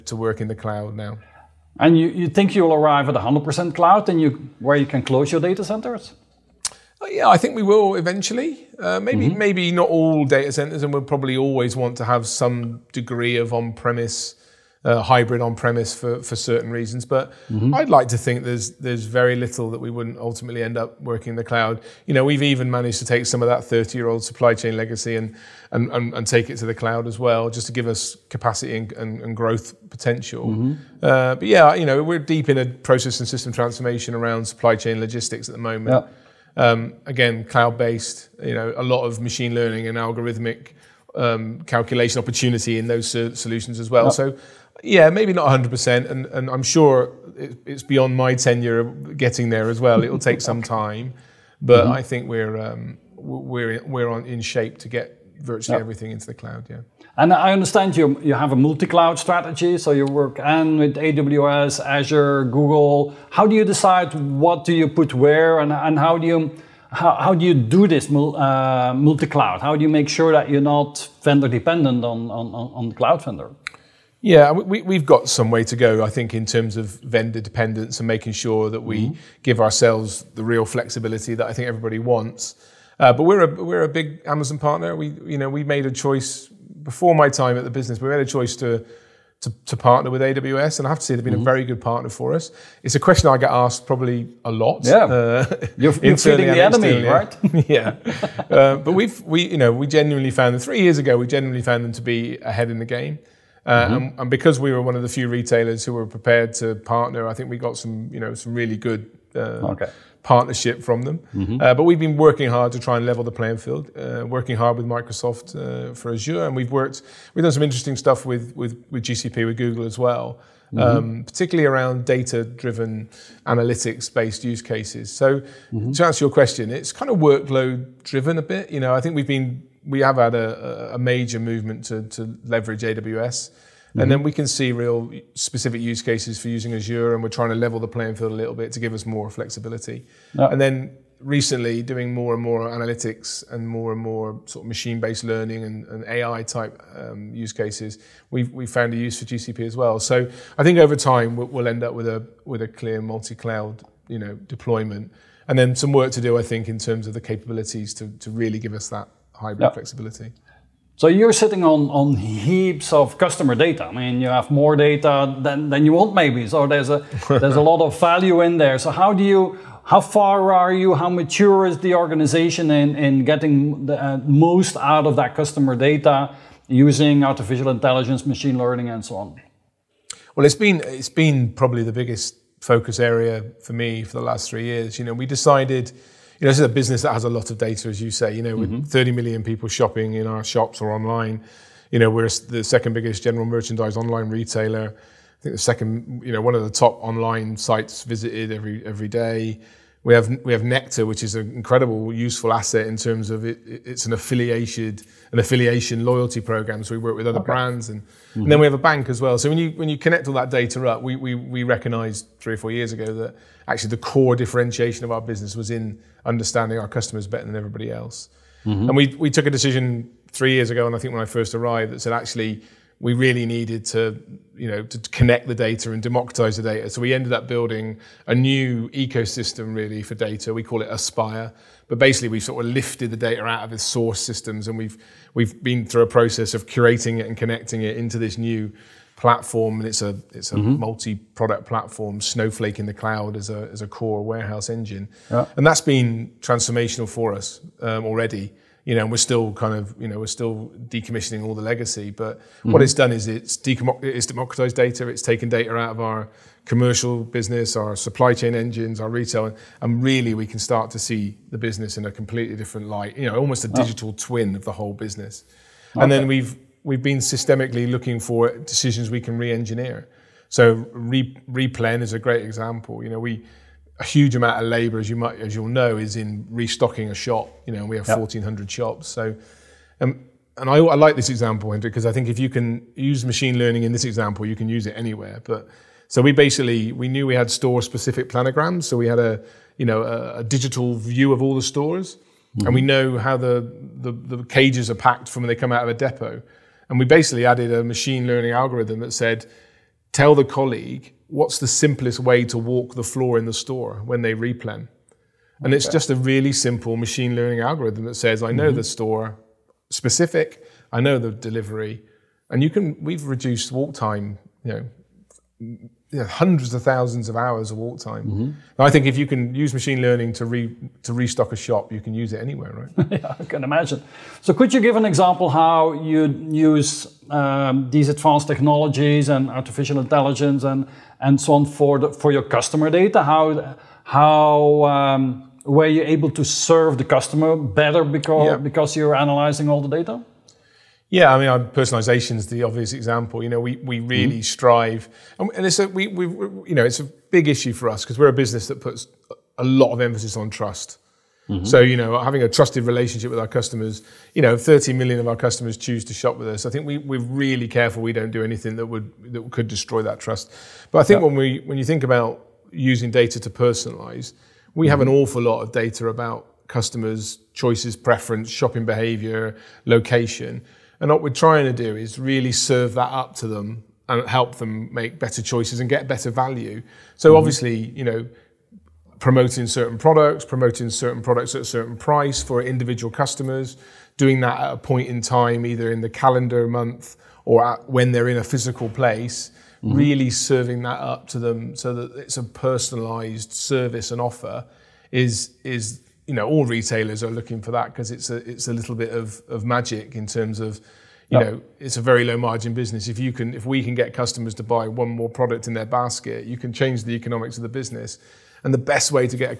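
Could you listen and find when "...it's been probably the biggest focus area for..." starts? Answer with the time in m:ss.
3:00.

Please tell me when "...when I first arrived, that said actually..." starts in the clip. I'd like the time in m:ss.
3:41.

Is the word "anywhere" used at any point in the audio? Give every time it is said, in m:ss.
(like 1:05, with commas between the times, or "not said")
4:44, 5:22.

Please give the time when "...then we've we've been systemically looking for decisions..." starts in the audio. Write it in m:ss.
4:26.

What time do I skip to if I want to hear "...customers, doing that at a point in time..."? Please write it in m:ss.
6:23.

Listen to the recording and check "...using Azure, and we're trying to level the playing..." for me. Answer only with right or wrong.
right.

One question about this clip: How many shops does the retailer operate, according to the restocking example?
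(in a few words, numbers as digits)
1,400.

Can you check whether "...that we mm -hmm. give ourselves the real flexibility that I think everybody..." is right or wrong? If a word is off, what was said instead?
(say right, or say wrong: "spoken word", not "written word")
right.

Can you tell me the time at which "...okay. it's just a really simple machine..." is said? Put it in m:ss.
5:05.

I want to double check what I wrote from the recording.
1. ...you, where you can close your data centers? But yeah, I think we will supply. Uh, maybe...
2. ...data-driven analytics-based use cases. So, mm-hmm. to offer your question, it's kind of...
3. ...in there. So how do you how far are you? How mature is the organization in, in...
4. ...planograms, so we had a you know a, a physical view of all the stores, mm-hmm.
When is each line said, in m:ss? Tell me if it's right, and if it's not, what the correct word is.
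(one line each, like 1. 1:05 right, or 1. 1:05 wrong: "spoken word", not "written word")
1. 0:04 wrong: "eventually", not "supply"
2. 2:02 wrong: "answer", not "offer"
3. 2:48 right
4. 4:48 wrong: "digital", not "physical".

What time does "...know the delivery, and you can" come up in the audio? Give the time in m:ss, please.
5:10.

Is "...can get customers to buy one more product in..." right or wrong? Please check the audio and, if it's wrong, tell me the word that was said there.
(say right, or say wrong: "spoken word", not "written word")
right.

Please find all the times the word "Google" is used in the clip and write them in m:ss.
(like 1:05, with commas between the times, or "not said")
1:02, 1:59.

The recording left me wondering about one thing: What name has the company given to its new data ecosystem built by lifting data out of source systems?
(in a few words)
Aspire.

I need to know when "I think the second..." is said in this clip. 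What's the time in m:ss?
3:15.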